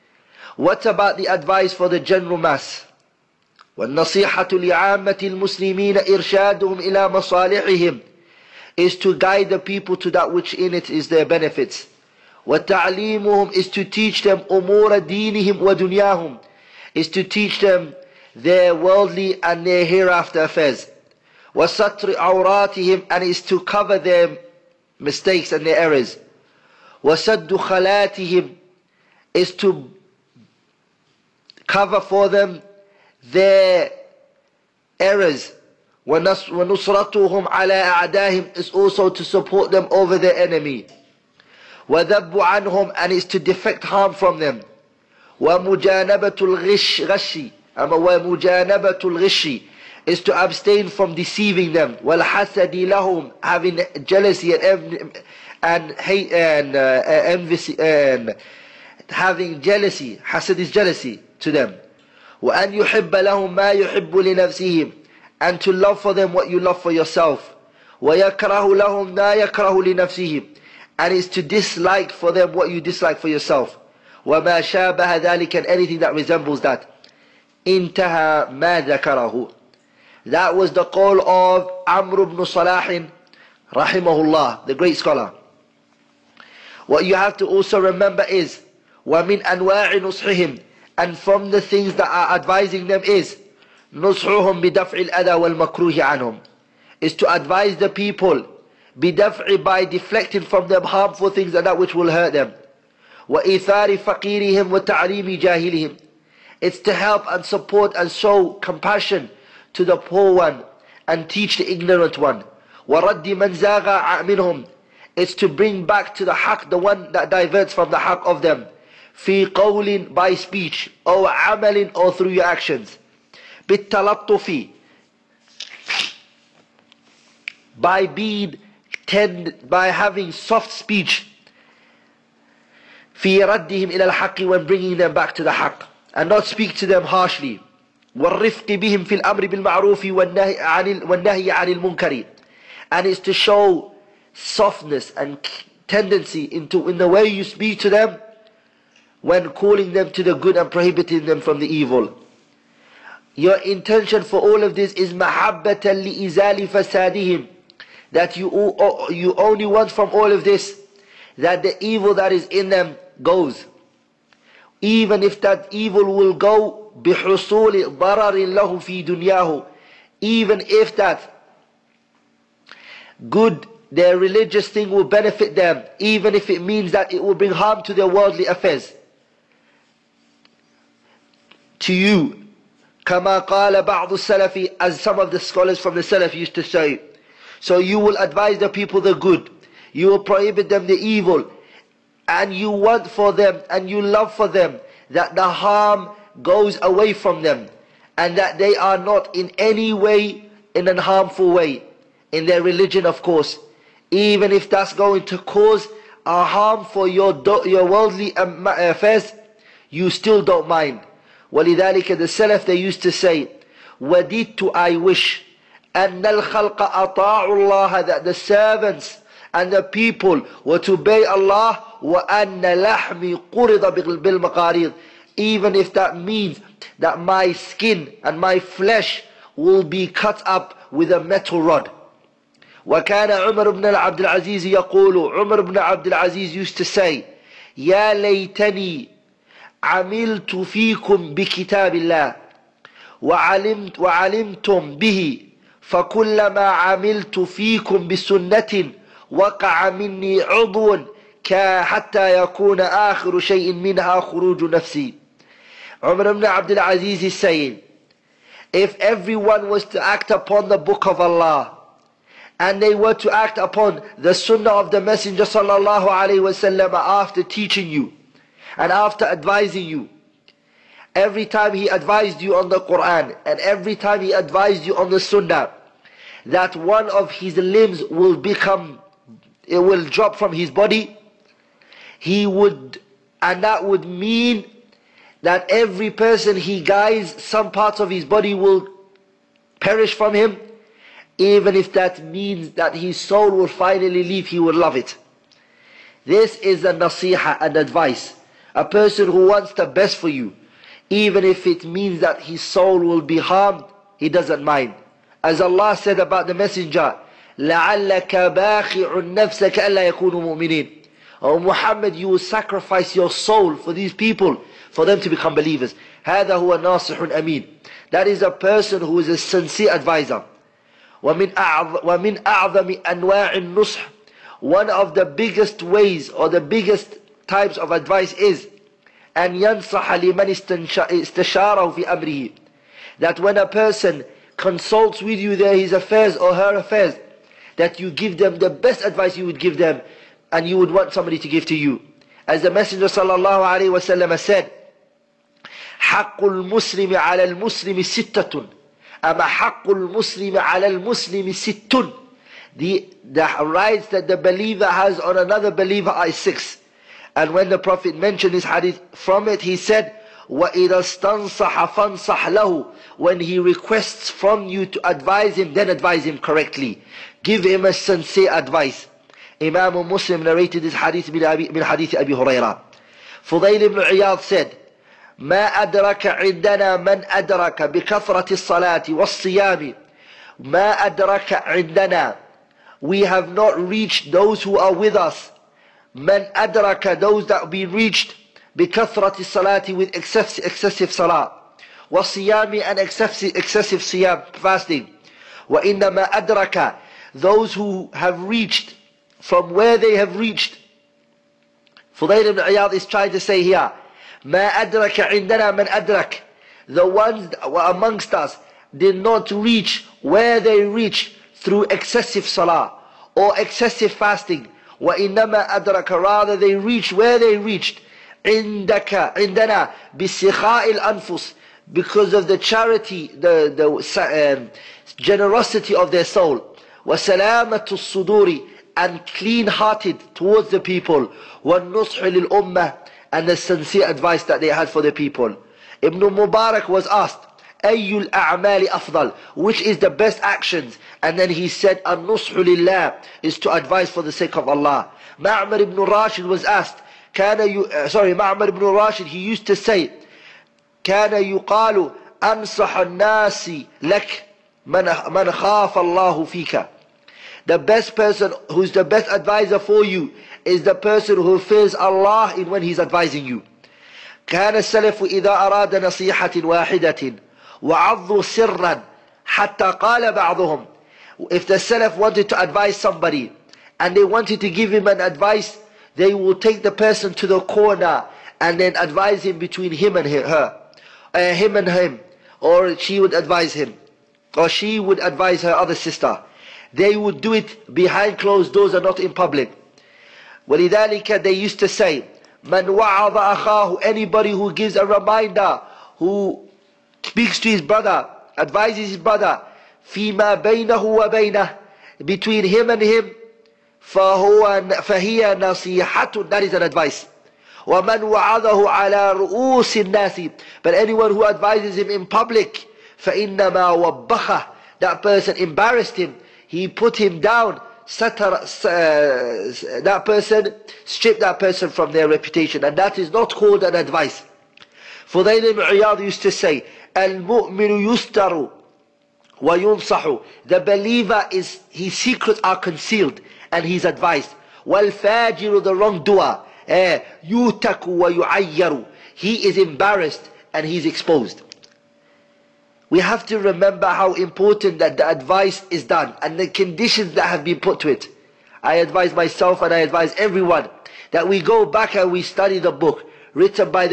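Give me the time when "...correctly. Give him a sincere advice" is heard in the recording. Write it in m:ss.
6:06.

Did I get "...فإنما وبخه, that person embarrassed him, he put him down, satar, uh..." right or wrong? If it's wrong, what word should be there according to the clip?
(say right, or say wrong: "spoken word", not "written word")
right.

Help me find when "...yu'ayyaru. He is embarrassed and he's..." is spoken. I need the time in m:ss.
8:58.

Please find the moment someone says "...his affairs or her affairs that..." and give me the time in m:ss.
5:35.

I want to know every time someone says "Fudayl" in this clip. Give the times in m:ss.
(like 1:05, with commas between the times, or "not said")
6:13, 6:42, 8:45.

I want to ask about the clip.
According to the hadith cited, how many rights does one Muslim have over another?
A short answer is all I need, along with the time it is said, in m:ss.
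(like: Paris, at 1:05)
6, at 5:48.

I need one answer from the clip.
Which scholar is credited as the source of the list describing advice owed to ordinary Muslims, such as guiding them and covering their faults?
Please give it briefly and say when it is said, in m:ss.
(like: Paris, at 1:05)
Amr ibn Salah, at 1:21.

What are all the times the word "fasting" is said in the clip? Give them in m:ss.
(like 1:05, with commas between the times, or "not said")
6:34, 6:54.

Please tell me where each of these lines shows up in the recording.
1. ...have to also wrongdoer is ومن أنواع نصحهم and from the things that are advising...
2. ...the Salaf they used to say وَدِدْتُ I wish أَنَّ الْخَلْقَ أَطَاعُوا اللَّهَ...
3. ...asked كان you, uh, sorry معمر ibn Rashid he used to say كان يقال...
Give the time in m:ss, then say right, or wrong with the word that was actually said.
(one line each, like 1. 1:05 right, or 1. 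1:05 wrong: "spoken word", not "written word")
1. 1:27 wrong: "remember", not "wrongdoer"
2. 3:32 right
3. 7:26 right.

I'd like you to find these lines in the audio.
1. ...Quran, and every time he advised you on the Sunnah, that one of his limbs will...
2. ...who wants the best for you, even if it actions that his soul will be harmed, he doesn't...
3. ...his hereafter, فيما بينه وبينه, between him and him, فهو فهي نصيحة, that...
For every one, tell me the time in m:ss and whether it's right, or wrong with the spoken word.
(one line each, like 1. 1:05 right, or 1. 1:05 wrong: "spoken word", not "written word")
1. 4:32 right
2. 4:59 wrong: "means", not "actions"
3. 8:19 wrong: "brother", not "hereafter".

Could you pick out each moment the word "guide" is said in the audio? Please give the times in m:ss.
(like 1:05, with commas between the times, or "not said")
0:09, 4:46.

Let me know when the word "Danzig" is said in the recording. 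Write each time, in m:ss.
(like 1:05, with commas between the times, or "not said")
not said.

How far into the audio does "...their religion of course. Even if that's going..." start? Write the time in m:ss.
3:22.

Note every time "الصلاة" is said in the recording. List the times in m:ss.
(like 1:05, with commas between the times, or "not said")
6:18, 6:29.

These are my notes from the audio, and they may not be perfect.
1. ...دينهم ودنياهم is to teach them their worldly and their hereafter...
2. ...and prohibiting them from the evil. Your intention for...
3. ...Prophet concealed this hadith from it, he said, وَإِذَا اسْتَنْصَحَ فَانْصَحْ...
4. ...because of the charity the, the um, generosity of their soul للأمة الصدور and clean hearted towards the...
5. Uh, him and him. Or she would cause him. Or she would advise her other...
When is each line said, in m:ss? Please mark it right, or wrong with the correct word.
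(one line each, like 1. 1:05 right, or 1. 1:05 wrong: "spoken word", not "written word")
1. 0:14 right
2. 2:30 right
3. 5:57 wrong: "mentioned", not "concealed"
4. 7:01 wrong: "وسلامة", not "للأمة"
5. 8:01 wrong: "advise", not "cause".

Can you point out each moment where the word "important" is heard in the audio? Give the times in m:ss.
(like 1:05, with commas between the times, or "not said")
9:04.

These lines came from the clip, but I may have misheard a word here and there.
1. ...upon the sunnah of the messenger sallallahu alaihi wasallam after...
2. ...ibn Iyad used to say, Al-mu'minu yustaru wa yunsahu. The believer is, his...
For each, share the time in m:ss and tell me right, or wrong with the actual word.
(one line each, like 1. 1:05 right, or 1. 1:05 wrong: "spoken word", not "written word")
1. 4:23 right
2. 8:45 right.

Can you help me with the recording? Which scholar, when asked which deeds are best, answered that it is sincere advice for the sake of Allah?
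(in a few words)
Ibn Mubarak.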